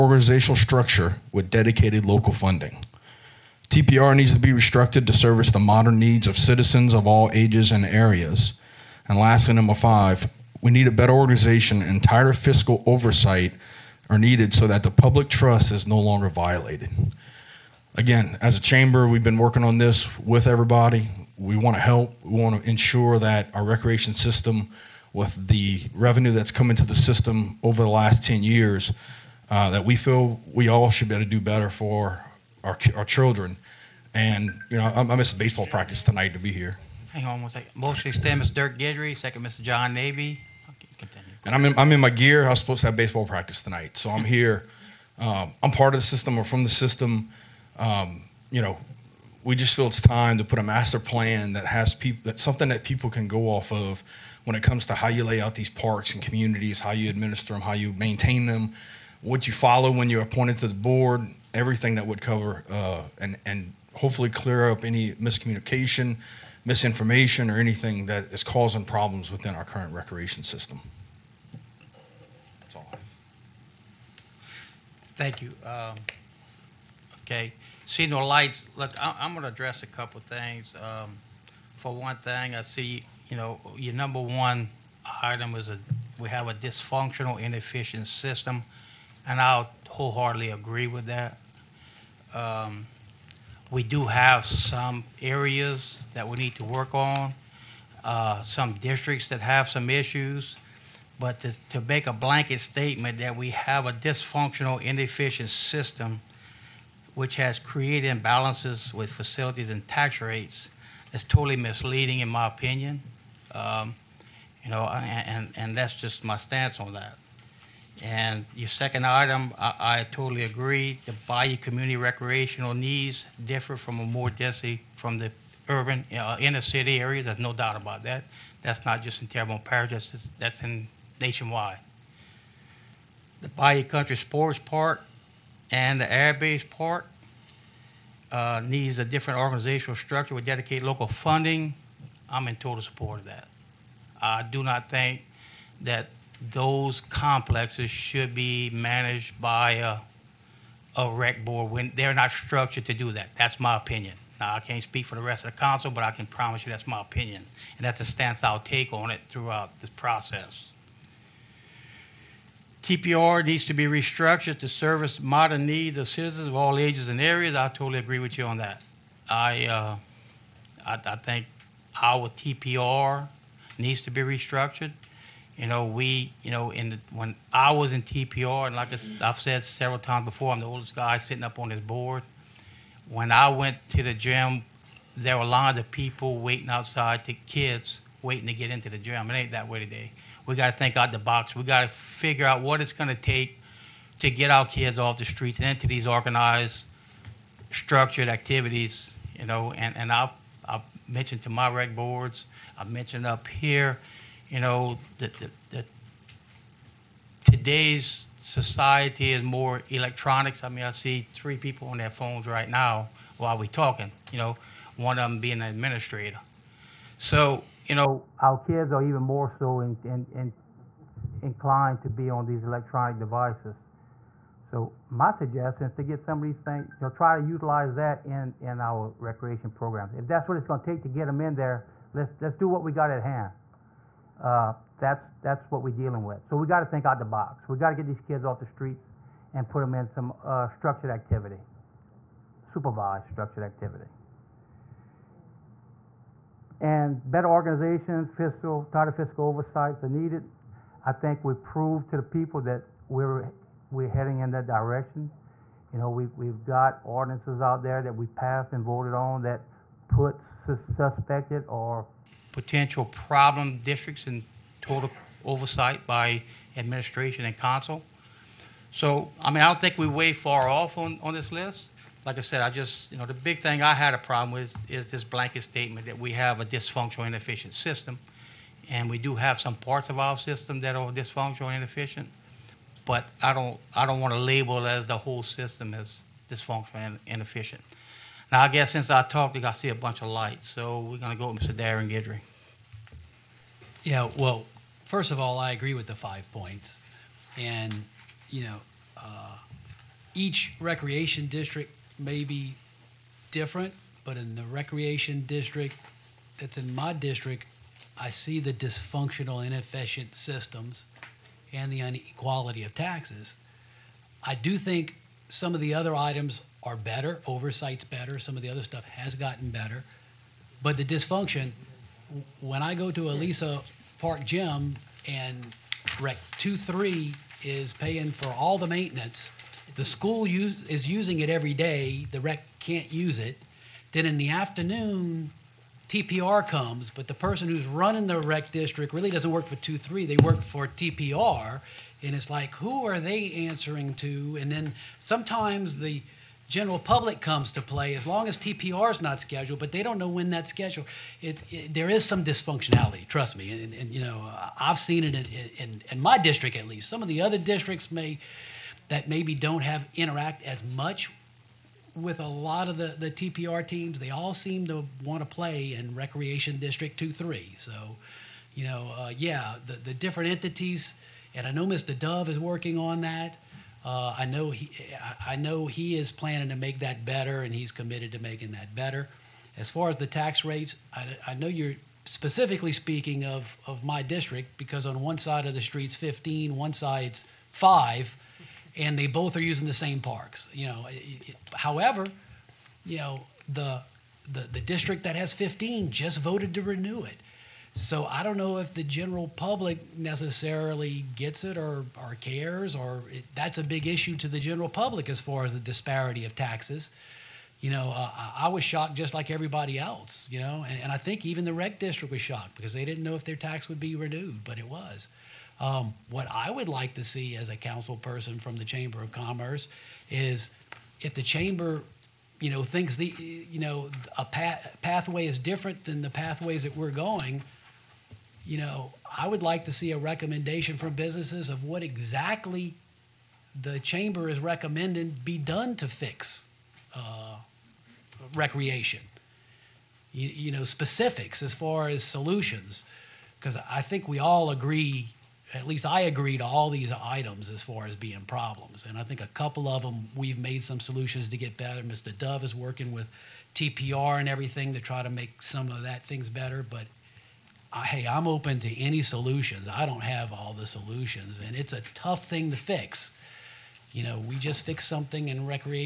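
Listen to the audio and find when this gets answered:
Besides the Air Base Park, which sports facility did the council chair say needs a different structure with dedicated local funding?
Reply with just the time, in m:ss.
2:13.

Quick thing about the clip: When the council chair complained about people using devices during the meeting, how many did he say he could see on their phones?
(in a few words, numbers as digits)
3.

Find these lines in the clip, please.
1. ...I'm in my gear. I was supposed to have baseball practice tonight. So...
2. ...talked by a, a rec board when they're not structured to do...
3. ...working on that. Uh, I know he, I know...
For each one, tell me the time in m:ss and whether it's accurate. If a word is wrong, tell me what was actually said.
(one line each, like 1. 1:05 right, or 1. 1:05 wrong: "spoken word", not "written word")
1. 0:41 right
2. 2:28 wrong: "managed", not "talked"
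3. 6:12 right.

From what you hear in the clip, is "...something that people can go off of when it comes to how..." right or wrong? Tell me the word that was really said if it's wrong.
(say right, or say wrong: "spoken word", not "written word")
right.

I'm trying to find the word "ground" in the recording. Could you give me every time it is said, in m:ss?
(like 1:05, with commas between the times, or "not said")
not said.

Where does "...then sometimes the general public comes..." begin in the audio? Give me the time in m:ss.
5:44.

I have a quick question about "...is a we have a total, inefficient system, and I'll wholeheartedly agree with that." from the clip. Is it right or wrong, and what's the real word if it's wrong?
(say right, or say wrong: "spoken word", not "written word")
wrong: "dysfunctional", not "total".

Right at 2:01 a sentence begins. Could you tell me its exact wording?
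The bayou community recreational needs differ from a more density from the urban uh, inner city area.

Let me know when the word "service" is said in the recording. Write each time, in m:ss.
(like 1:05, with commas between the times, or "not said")
0:05, 2:44.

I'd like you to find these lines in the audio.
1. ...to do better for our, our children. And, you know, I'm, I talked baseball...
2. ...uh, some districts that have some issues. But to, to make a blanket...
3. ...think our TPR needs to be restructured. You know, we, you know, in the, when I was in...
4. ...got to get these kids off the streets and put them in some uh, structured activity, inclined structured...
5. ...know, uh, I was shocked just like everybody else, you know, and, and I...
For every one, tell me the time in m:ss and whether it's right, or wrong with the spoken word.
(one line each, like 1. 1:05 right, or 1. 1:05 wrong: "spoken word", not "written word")
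1. 0:31 wrong: "missed", not "talked"
2. 1:38 right
3. 2:51 right
4. 3:57 wrong: "supervised", not "inclined"
5. 6:47 right.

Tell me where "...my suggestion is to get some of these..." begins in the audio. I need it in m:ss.
3:45.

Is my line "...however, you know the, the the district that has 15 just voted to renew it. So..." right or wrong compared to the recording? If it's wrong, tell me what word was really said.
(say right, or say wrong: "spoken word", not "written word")
right.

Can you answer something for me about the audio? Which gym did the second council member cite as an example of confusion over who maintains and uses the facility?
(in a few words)
Elisa Park Gym.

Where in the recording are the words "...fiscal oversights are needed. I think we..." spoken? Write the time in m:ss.
4:09.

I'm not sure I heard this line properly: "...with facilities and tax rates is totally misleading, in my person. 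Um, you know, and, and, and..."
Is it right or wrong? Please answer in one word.
wrong.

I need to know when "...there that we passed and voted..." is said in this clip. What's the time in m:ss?
4:17.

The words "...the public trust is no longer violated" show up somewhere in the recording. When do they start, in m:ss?
0:14.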